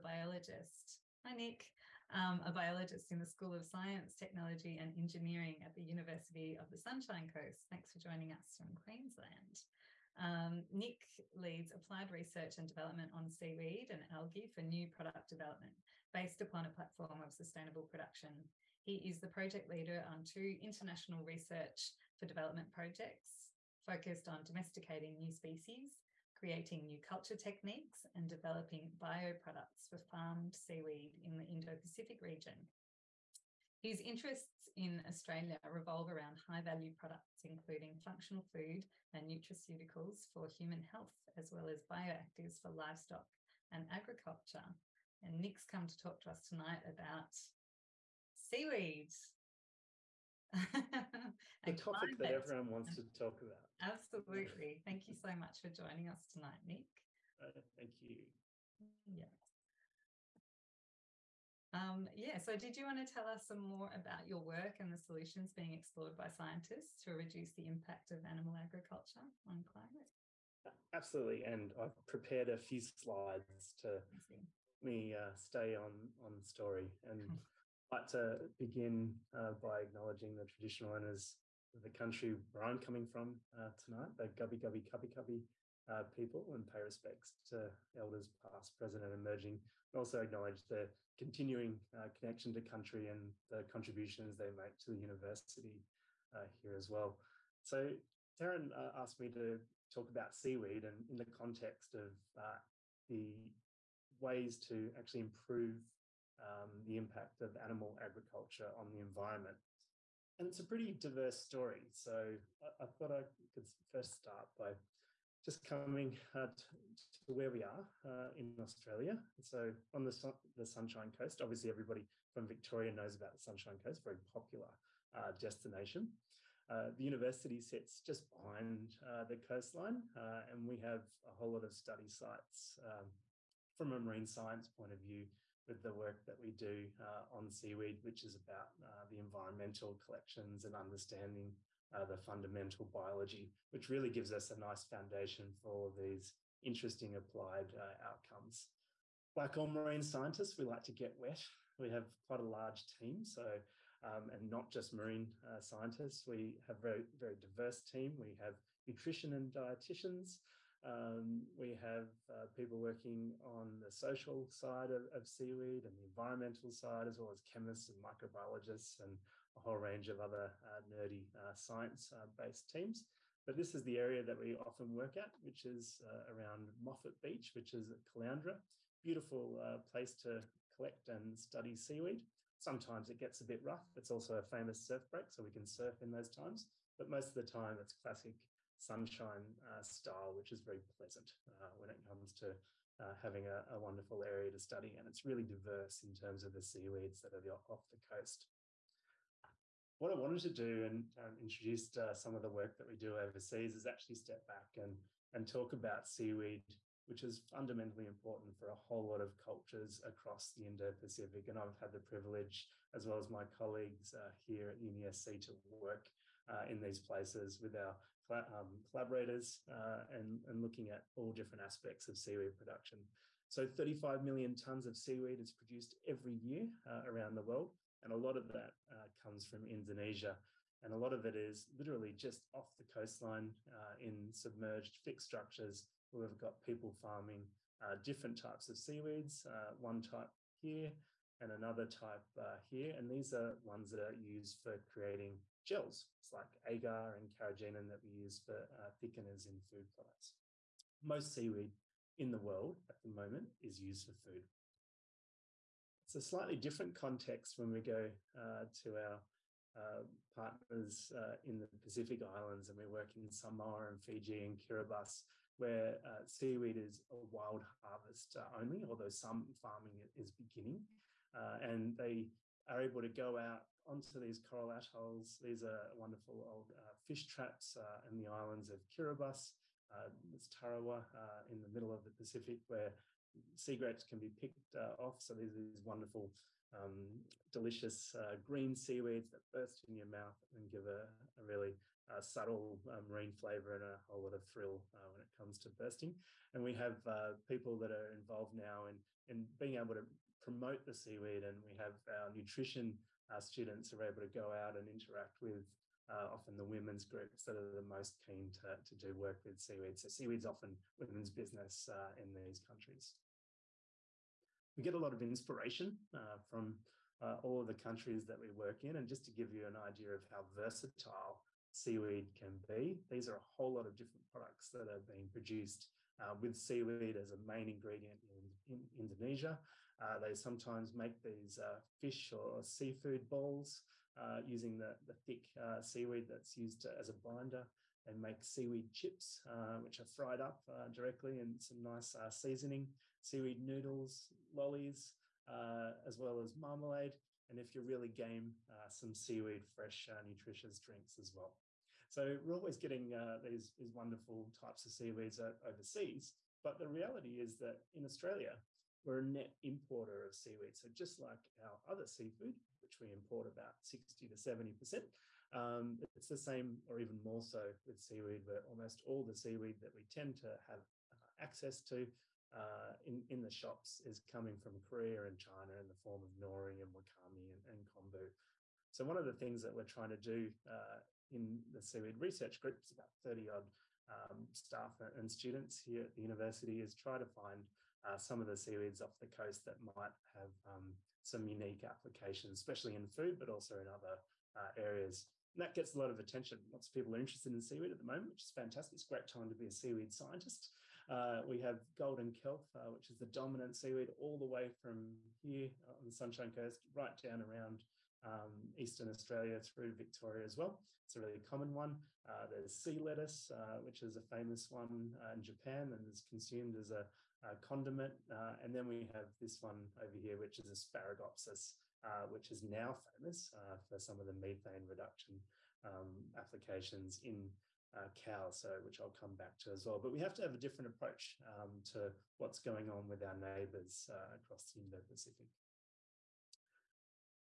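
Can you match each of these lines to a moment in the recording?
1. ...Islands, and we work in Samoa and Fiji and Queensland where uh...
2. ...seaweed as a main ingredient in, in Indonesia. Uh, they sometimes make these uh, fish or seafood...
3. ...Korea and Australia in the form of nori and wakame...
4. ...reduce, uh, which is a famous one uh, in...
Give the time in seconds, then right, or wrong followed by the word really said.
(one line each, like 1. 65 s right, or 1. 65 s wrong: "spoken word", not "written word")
1. 262 s wrong: "Kiribati", not "Queensland"
2. 326 s right
3. 374 s wrong: "China", not "Australia"
4. 412 s wrong: "lettuce", not "reduce".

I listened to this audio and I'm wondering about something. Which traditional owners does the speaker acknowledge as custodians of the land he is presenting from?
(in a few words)
Gubbi Gubbi Kabi Kabi.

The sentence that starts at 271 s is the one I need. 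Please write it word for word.
Uh, and they are able to go out onto these coral atolls.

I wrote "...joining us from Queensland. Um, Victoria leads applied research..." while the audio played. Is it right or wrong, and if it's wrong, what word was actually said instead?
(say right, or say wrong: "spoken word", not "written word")
wrong: "Nick", not "Victoria".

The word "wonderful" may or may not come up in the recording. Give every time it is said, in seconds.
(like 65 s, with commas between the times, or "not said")
193 s, 275 s, 285 s, 353 s.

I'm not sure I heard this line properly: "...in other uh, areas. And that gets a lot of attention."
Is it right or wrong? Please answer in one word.
right.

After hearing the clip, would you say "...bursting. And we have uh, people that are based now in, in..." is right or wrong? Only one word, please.
wrong.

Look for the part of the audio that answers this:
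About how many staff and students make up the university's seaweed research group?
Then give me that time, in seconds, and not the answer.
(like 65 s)
382 s.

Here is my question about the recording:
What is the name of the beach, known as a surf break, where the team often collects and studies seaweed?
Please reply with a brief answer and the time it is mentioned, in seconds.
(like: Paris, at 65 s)
Moffat Beach, at 176 s.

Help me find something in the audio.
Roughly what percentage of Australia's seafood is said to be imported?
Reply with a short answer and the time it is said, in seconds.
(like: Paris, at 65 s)
60 to 70%, at 363 s.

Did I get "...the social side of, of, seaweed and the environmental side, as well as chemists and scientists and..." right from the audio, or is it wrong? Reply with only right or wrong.
wrong.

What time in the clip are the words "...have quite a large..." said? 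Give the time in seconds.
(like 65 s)
151 s.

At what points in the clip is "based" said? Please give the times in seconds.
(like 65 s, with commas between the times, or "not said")
16 s, 172 s.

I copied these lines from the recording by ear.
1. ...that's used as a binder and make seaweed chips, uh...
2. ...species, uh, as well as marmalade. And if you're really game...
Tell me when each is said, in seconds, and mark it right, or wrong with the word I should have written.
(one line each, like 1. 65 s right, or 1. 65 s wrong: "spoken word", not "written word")
1. 336 s right
2. 344 s wrong: "lollies", not "species".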